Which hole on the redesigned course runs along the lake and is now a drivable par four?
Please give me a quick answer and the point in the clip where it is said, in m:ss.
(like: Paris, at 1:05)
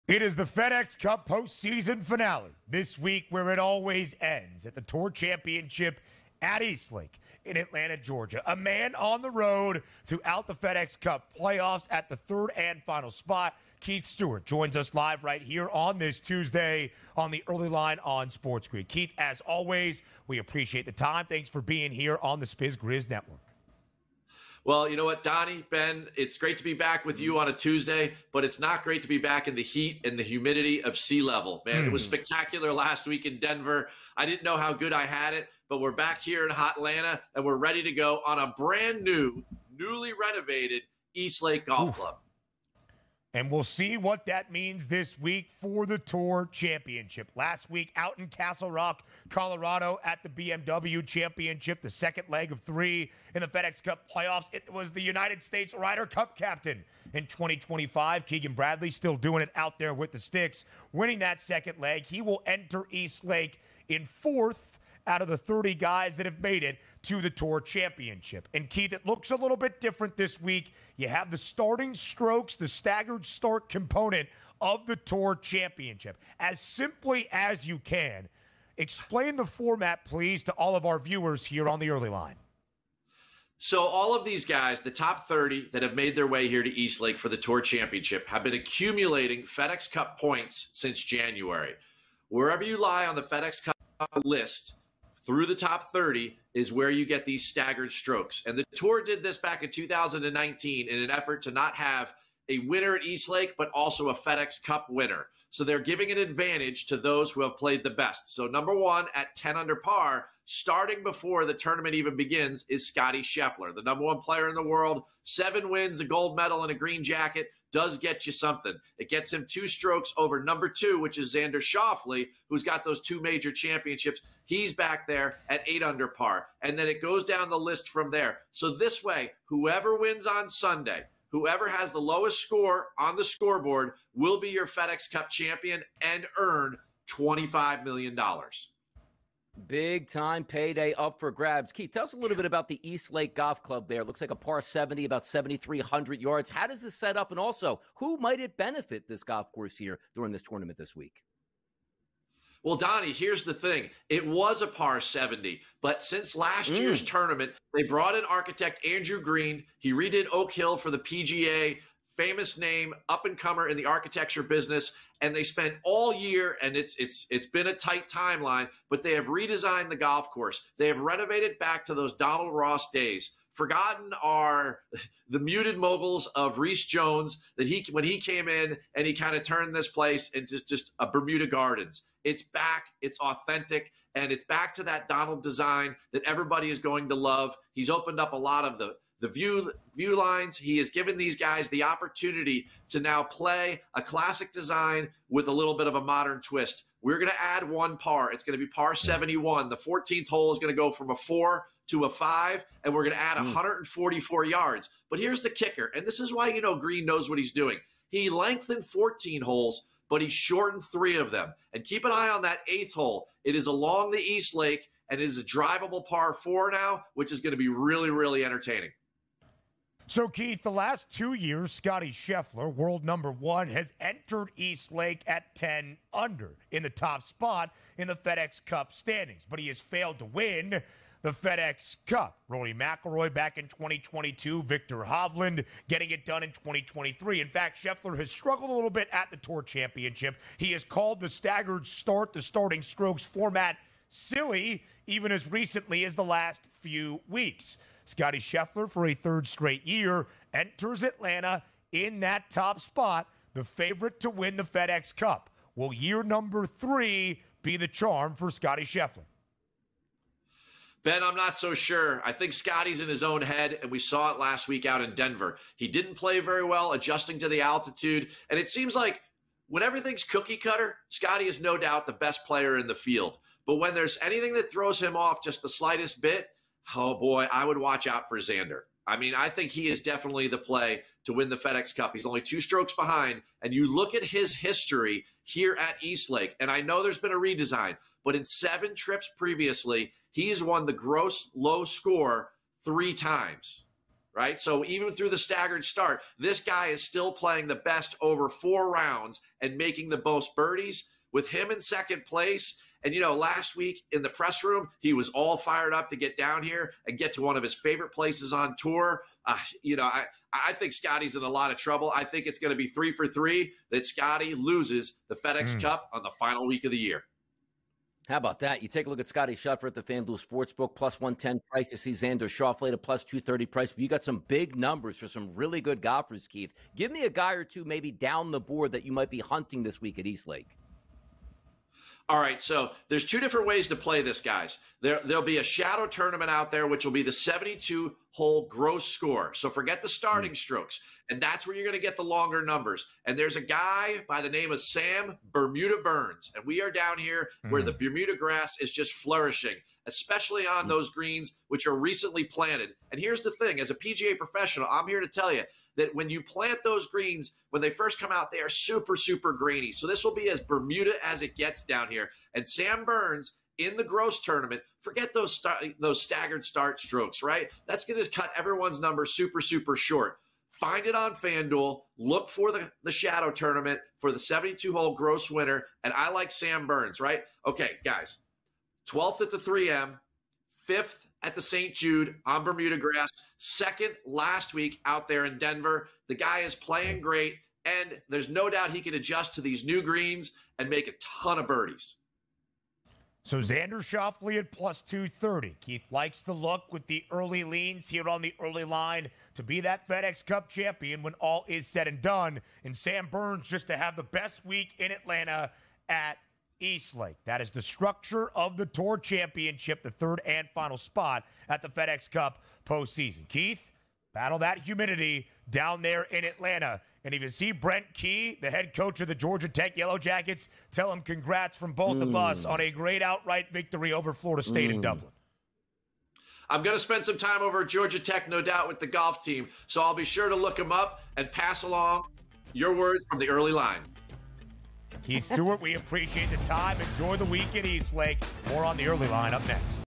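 8th hole, at 3:32.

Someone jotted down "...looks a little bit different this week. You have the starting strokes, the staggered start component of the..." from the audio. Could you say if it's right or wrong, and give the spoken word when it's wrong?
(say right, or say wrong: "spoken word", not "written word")
right.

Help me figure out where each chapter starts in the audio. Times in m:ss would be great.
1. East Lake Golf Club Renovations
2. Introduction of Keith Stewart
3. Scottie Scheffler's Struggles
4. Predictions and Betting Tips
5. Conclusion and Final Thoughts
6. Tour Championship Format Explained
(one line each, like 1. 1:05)
1. 2:21
2. 0:13
3. 3:40
4. 5:26
5. 6:46
6. 1:10.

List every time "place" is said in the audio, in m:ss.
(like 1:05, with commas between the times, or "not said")
2:59, 5:02, 5:08.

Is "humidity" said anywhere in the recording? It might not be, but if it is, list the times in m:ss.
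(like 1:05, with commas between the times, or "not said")
0:30, 6:54.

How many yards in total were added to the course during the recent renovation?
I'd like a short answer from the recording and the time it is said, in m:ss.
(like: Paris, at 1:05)
144, at 3:23.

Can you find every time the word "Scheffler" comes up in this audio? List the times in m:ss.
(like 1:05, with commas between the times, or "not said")
1:53, 3:42, 3:57, 4:08, 4:18, 5:19.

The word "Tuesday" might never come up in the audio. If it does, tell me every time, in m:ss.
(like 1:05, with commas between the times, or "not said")
0:16, 0:27.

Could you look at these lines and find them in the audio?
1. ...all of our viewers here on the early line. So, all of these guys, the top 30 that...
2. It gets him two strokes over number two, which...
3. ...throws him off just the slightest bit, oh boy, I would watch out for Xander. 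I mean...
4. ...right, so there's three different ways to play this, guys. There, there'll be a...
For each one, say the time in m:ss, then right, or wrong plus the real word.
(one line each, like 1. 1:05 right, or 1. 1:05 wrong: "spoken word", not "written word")
1. 1:20 right
2. 1:58 right
3. 4:34 right
4. 5:32 wrong: "two", not "three".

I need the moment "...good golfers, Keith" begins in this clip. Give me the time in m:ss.
5:25.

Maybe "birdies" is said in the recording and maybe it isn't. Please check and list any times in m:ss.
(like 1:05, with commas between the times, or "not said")
5:00, 6:31.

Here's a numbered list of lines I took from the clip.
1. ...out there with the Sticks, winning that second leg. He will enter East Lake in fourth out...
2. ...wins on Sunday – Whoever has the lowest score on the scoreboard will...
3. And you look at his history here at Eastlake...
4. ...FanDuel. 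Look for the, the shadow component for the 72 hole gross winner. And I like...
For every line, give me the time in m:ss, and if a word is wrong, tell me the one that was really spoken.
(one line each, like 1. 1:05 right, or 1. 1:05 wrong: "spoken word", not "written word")
1. 0:59 right
2. 2:09 right
3. 4:43 right
4. 6:11 wrong: "tournament", not "component".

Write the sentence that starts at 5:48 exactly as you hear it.
Bermuda grass is just flourishing, especially on hmm.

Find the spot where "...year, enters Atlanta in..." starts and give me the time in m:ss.
4:09.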